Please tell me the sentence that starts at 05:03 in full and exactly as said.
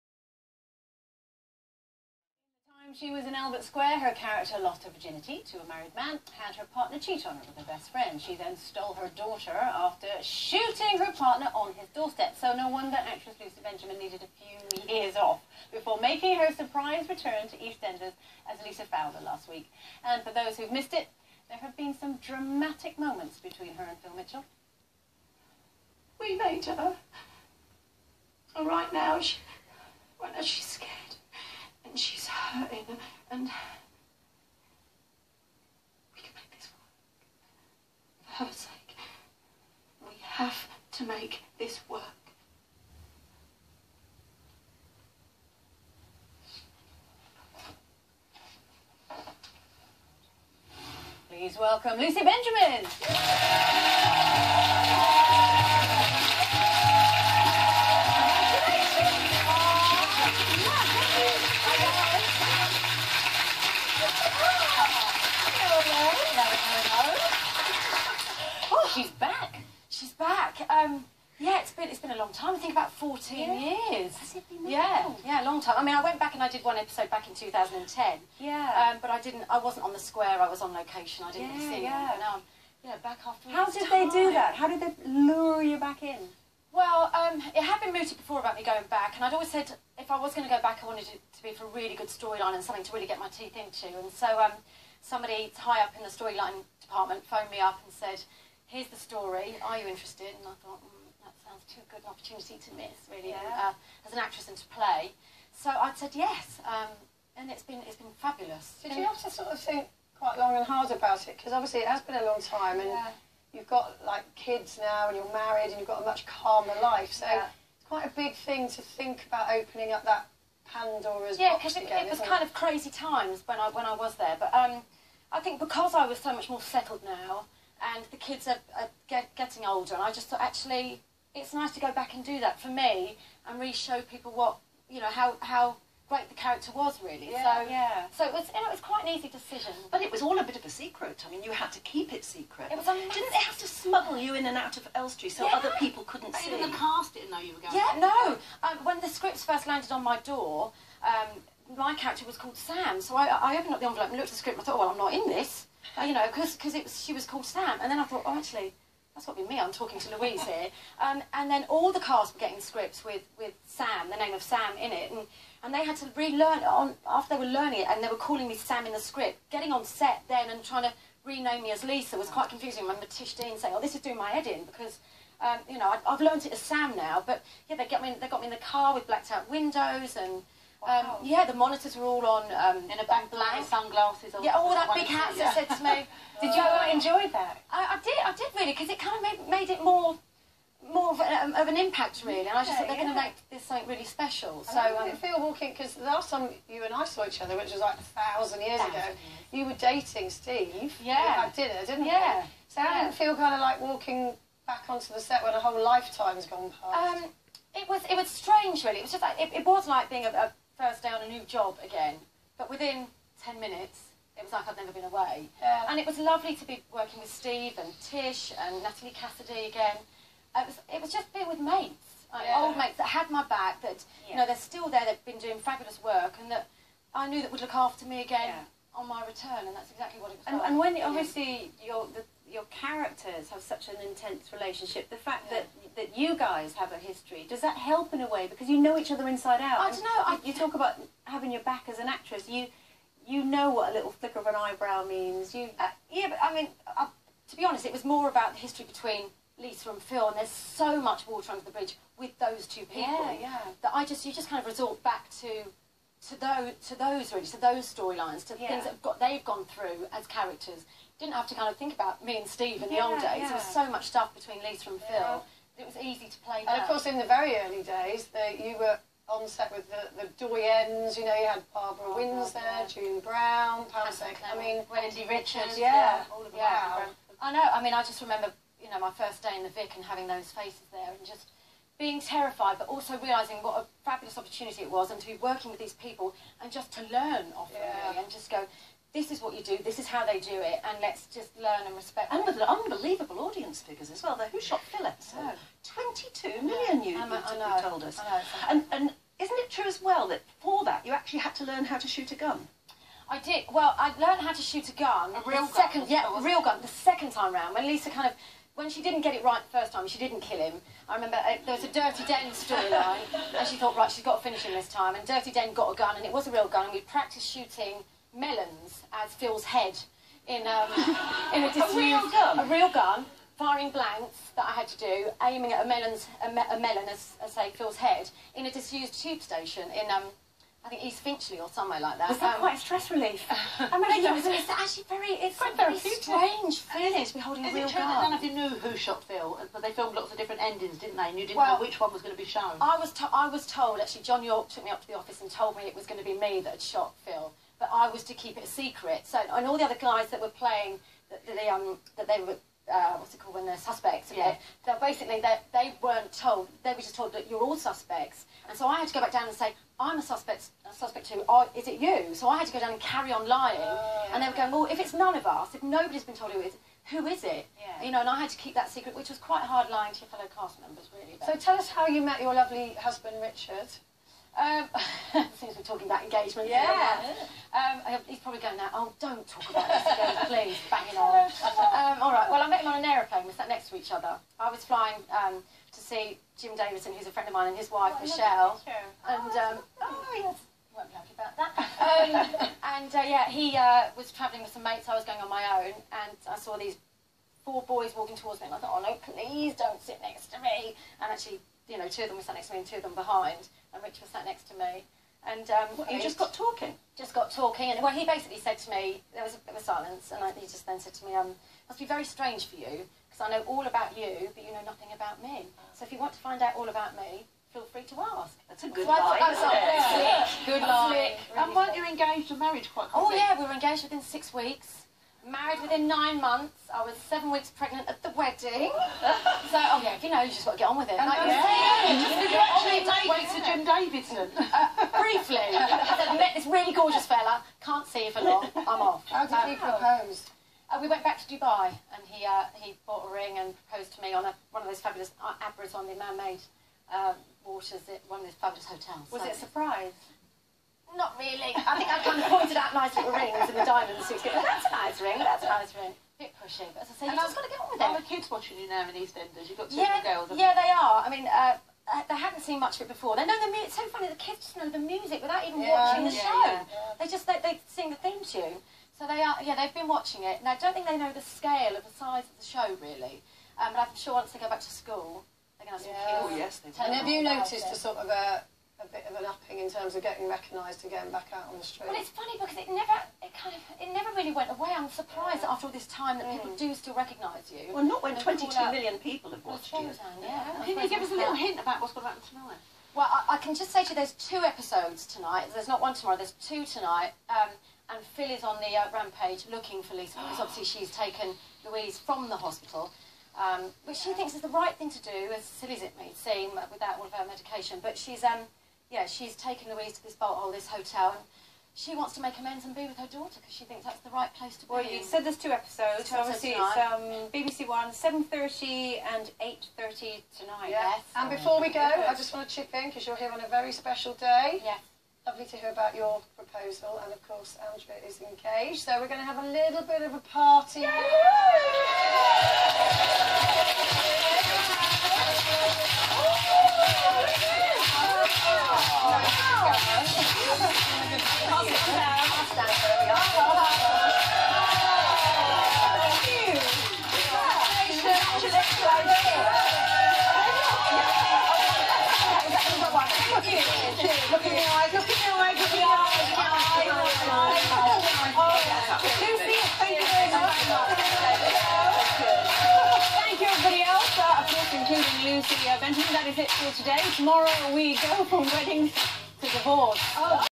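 Well, I learned how to shoot a gun.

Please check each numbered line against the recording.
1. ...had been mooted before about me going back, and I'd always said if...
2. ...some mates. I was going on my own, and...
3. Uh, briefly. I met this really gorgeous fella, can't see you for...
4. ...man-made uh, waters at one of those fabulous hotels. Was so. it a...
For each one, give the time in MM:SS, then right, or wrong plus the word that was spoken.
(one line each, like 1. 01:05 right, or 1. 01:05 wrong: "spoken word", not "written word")
1. 01:27 right
2. 06:34 right
3. 07:14 right
4. 07:26 right.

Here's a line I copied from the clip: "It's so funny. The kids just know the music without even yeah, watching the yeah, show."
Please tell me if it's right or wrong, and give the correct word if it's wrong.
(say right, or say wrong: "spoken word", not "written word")
right.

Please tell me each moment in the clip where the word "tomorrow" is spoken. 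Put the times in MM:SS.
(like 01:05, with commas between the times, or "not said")
08:16, 09:27.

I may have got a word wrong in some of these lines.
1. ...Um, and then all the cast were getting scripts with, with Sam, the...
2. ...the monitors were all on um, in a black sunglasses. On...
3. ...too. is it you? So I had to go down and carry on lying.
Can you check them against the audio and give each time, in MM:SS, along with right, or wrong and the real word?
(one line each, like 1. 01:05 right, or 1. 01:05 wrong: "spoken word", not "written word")
1. 02:41 right
2. 03:01 right
3. 06:01 right.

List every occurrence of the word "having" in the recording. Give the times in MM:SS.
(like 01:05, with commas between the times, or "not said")
04:01, 04:40.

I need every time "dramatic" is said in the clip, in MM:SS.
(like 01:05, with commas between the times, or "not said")
00:22.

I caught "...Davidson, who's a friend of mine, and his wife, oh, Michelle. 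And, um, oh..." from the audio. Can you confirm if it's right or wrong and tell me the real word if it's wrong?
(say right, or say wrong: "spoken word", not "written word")
right.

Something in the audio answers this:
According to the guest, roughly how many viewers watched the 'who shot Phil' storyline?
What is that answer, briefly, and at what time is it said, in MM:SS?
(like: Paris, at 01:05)
22 million, at 08:08.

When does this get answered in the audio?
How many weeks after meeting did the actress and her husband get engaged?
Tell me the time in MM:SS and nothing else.
07:04.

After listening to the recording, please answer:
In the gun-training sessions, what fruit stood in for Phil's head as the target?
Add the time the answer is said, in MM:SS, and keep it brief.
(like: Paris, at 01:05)
Melons, at 05:16.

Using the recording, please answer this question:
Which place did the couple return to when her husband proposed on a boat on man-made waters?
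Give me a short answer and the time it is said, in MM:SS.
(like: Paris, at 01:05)
Dubai, at 07:21.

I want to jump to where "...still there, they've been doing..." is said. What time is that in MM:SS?
03:44.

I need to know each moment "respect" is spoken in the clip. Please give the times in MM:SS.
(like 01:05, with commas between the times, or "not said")
04:51.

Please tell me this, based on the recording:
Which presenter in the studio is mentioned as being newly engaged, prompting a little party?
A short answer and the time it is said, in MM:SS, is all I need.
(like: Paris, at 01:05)
Andrea, at 08:47.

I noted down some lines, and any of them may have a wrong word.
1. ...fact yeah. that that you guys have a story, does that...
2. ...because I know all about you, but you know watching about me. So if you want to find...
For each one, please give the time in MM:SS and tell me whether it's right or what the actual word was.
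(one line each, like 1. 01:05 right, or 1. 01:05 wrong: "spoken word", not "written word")
1. 03:55 wrong: "history", not "story"
2. 06:53 wrong: "nothing", not "watching".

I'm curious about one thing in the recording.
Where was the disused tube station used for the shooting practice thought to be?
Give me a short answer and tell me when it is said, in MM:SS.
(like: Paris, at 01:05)
East Finchley, at 05:31.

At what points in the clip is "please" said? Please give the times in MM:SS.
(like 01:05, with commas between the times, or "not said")
00:51, 06:20, 06:39.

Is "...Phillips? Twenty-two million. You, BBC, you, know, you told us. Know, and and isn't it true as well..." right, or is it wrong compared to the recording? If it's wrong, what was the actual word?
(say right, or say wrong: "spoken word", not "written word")
wrong: "Emma", not "BBC".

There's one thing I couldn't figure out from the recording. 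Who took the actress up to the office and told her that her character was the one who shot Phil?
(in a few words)
John Yorke.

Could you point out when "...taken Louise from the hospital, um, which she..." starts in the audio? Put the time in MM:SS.
08:21.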